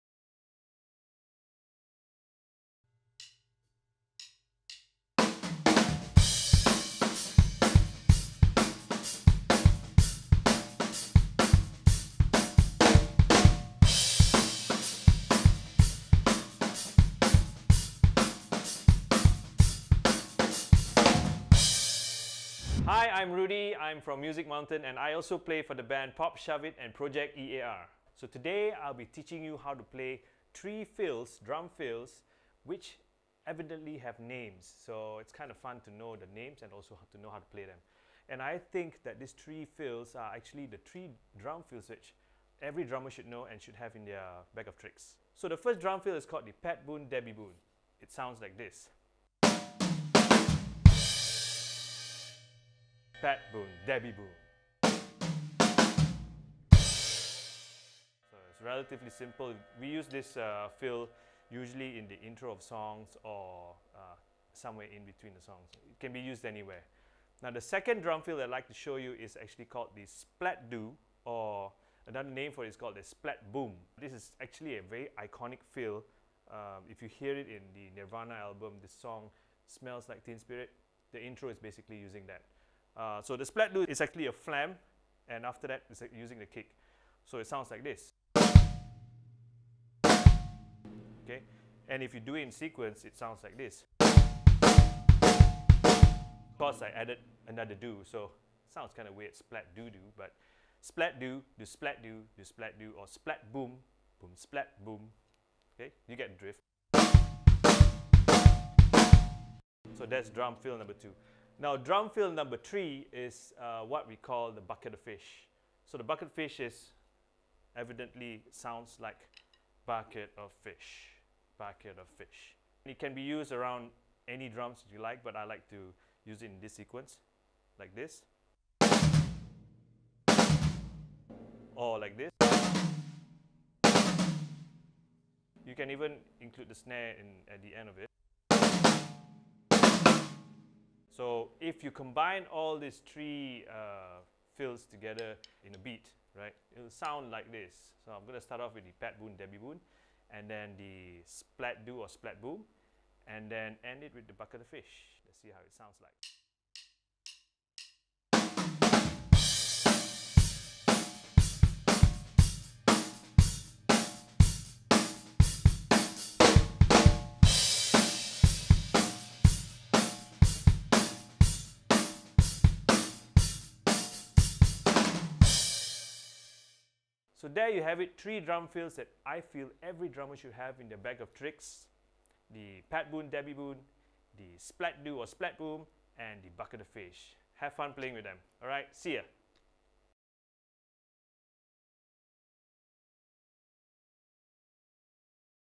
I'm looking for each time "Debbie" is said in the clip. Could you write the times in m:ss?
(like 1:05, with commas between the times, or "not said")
0:47, 0:53, 2:29, 3:03.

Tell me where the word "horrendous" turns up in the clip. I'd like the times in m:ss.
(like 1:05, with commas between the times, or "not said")
not said.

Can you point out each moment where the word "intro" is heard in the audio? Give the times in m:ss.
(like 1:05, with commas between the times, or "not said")
1:02, 1:21.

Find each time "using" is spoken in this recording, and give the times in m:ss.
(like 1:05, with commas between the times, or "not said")
1:21, 1:26.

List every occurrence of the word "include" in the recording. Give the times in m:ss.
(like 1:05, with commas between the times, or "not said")
2:16.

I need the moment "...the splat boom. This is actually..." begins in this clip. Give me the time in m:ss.
1:12.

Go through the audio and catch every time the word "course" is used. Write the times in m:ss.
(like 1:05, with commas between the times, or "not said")
1:36.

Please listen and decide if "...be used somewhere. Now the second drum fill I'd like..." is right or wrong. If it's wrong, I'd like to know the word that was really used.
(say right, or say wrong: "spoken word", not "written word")
wrong: "anywhere", not "somewhere".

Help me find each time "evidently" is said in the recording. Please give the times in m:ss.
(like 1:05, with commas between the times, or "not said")
0:33, 1:57.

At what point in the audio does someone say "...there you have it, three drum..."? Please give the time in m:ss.
2:57.